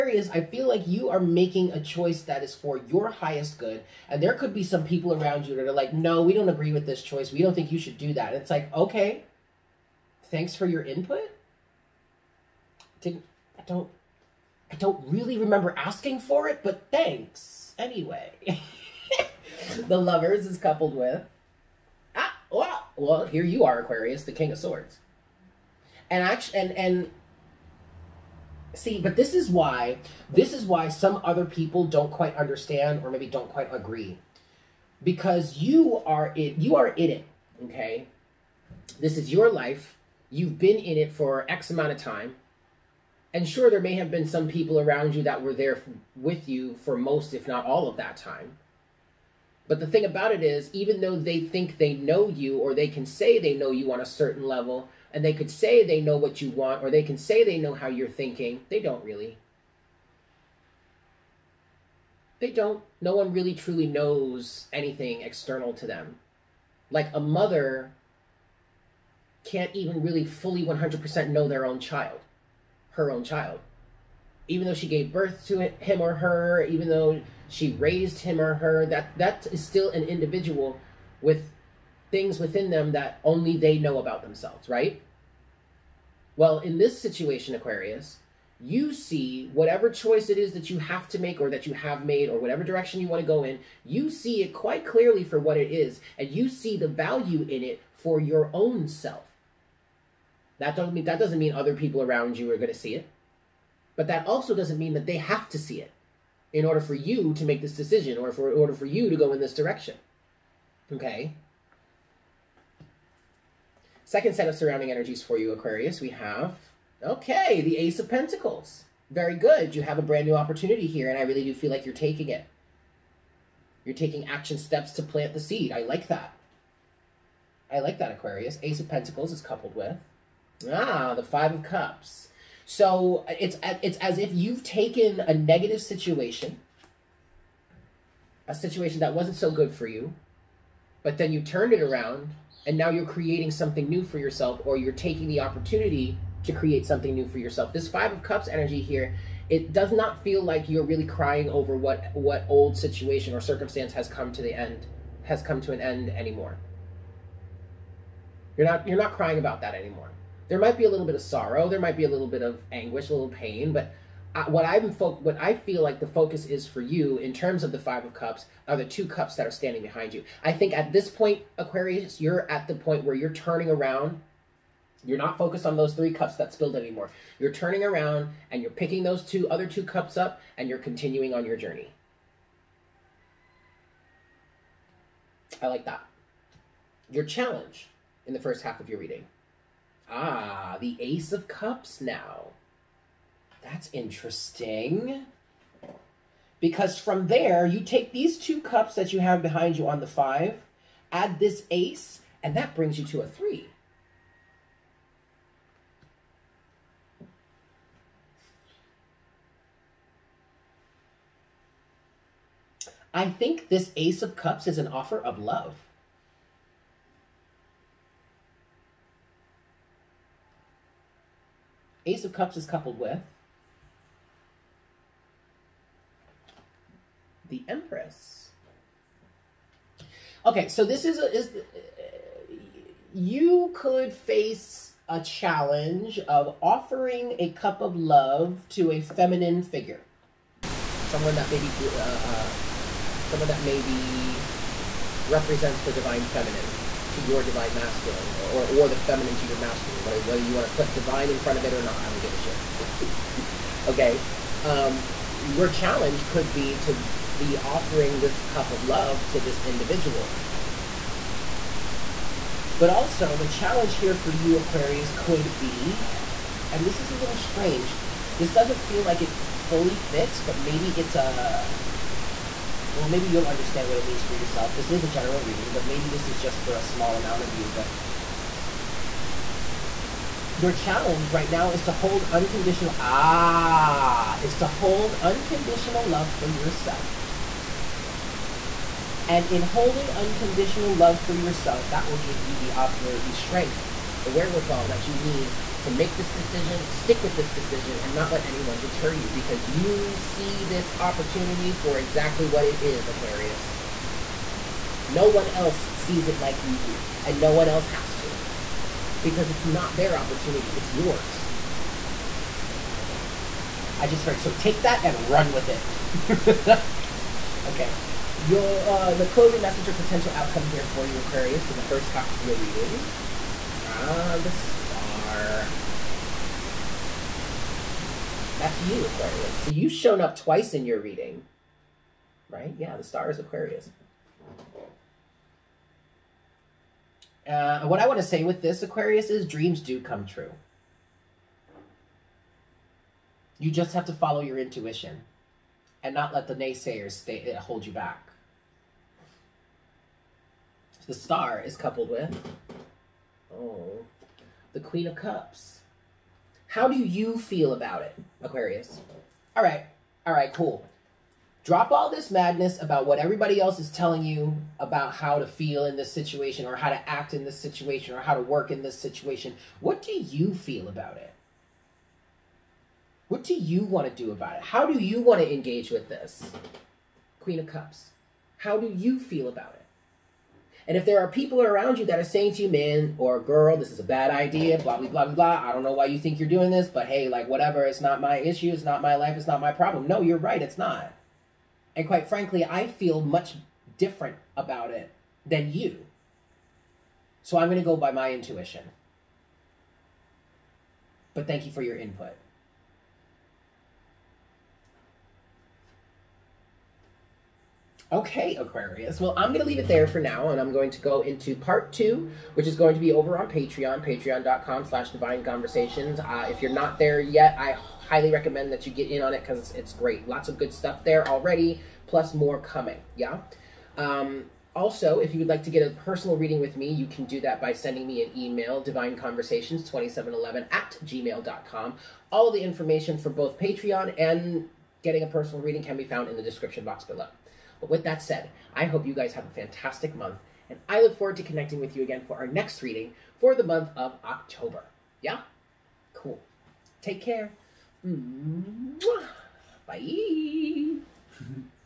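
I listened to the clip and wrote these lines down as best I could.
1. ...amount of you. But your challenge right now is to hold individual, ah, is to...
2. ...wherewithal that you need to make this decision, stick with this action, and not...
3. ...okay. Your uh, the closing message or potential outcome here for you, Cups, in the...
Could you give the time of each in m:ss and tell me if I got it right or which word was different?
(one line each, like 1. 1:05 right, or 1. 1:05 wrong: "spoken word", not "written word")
1. 4:37 wrong: "unconditional", not "individual"
2. 4:54 wrong: "decision", not "action"
3. 5:17 wrong: "Aquarius", not "Cups".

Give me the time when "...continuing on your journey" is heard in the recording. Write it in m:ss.
3:00.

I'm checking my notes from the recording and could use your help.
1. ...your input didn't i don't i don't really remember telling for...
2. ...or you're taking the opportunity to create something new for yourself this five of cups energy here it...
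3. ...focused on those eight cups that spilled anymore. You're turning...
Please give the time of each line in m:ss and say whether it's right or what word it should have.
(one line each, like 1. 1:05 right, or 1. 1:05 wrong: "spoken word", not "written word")
1. 0:10 wrong: "asking", not "telling"
2. 2:24 right
3. 2:55 wrong: "three", not "eight".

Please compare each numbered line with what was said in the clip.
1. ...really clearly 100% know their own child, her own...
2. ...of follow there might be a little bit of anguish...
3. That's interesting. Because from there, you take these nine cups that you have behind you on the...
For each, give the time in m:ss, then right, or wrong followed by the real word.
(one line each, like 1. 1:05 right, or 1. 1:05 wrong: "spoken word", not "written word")
1. 1:10 wrong: "fully", not "clearly"
2. 2:41 wrong: "sorrow", not "follow"
3. 3:13 wrong: "two", not "nine".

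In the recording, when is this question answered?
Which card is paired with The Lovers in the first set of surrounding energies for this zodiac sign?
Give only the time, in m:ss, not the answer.
0:24.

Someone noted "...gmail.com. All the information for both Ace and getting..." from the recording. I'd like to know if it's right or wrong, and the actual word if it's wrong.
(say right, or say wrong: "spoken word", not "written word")
wrong: "Patreon", not "Ace".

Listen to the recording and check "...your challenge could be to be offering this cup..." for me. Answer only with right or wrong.
right.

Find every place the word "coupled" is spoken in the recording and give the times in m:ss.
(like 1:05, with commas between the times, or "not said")
0:20, 2:09, 3:42, 5:51.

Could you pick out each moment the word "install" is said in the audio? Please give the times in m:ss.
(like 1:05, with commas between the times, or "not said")
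not said.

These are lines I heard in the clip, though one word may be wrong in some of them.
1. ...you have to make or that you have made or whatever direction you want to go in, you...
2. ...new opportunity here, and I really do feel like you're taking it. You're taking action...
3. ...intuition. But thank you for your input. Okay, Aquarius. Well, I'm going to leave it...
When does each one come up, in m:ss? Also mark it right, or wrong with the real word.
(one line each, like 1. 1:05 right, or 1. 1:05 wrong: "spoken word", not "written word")
1. 1:30 right
2. 2:00 right
3. 6:38 right.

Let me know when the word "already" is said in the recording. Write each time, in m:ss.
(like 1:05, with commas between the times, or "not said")
7:01.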